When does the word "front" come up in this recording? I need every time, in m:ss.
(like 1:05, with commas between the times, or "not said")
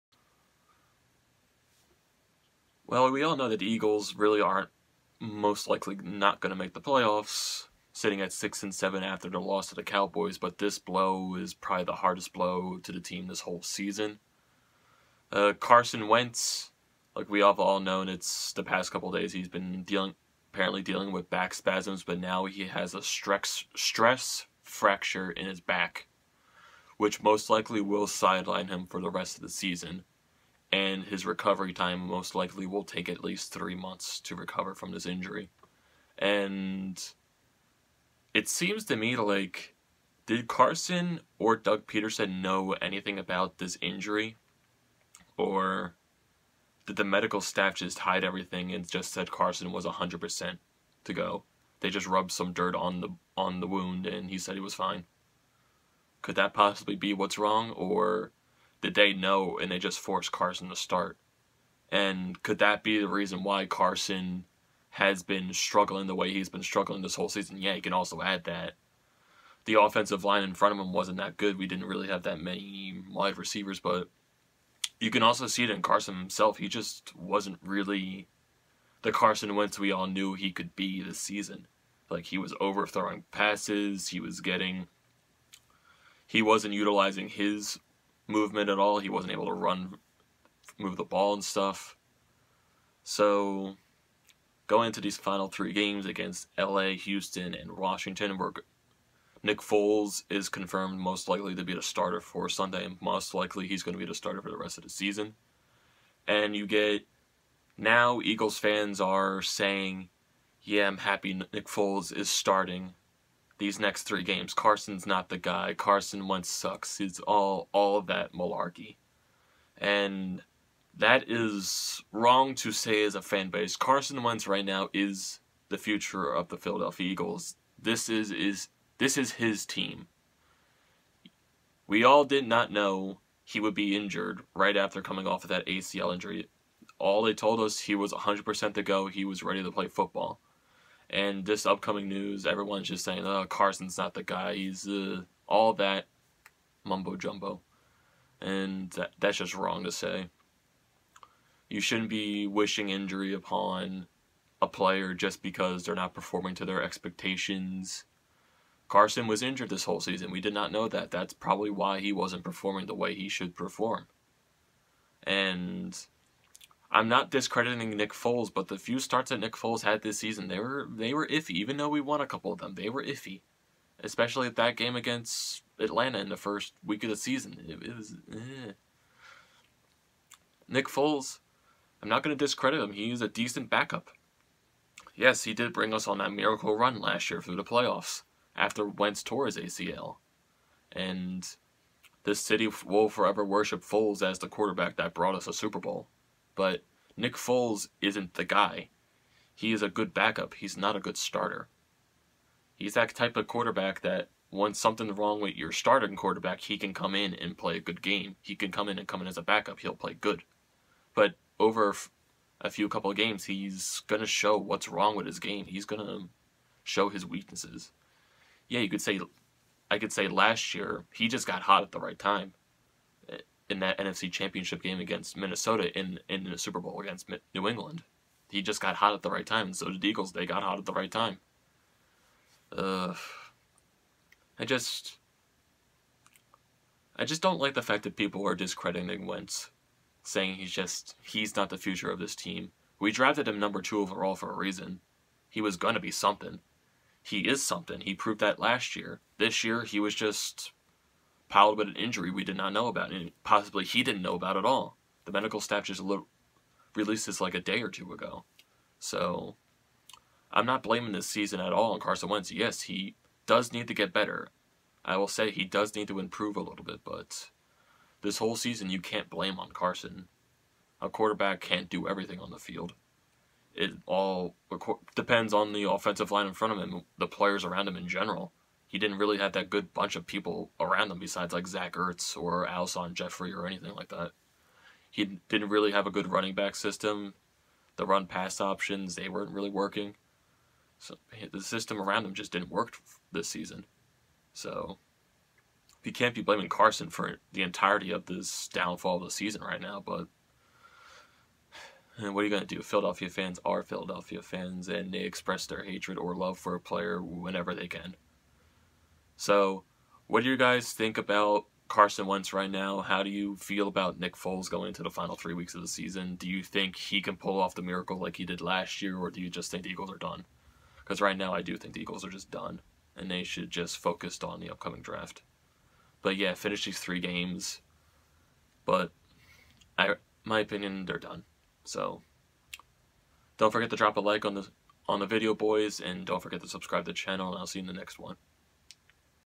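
1:10, 4:36.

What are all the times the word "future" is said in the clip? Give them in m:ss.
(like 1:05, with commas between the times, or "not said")
2:05, 4:01.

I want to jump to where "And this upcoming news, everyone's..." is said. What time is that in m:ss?
2:21.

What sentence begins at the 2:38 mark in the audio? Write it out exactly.
Carson was injured this whole season.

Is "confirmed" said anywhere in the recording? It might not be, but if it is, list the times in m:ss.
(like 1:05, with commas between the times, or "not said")
1:40.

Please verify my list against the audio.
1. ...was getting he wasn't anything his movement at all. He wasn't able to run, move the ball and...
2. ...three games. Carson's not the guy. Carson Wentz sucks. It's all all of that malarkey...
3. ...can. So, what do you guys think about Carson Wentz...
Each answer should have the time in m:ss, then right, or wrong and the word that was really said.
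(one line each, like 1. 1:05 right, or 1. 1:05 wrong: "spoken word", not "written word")
1. 1:24 wrong: "utilizing", not "anything"
2. 1:54 right
3. 5:07 right.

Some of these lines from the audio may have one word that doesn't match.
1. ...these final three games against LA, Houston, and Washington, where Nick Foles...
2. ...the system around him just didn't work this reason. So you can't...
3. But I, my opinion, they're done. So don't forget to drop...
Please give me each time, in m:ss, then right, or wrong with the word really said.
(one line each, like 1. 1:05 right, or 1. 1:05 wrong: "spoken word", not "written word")
1. 1:35 right
2. 4:51 wrong: "season", not "reason"
3. 5:28 right.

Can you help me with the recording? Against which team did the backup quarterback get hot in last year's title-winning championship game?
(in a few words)
New England.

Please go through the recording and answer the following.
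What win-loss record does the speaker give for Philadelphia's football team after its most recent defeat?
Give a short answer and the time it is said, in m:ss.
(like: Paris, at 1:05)
6-7, at 0:08.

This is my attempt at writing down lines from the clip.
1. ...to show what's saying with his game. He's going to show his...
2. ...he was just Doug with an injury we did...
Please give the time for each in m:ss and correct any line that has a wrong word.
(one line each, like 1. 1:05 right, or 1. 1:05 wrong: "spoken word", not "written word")
1. 3:34 wrong: "wrong", not "saying"
2. 4:09 wrong: "Piled", not "Doug".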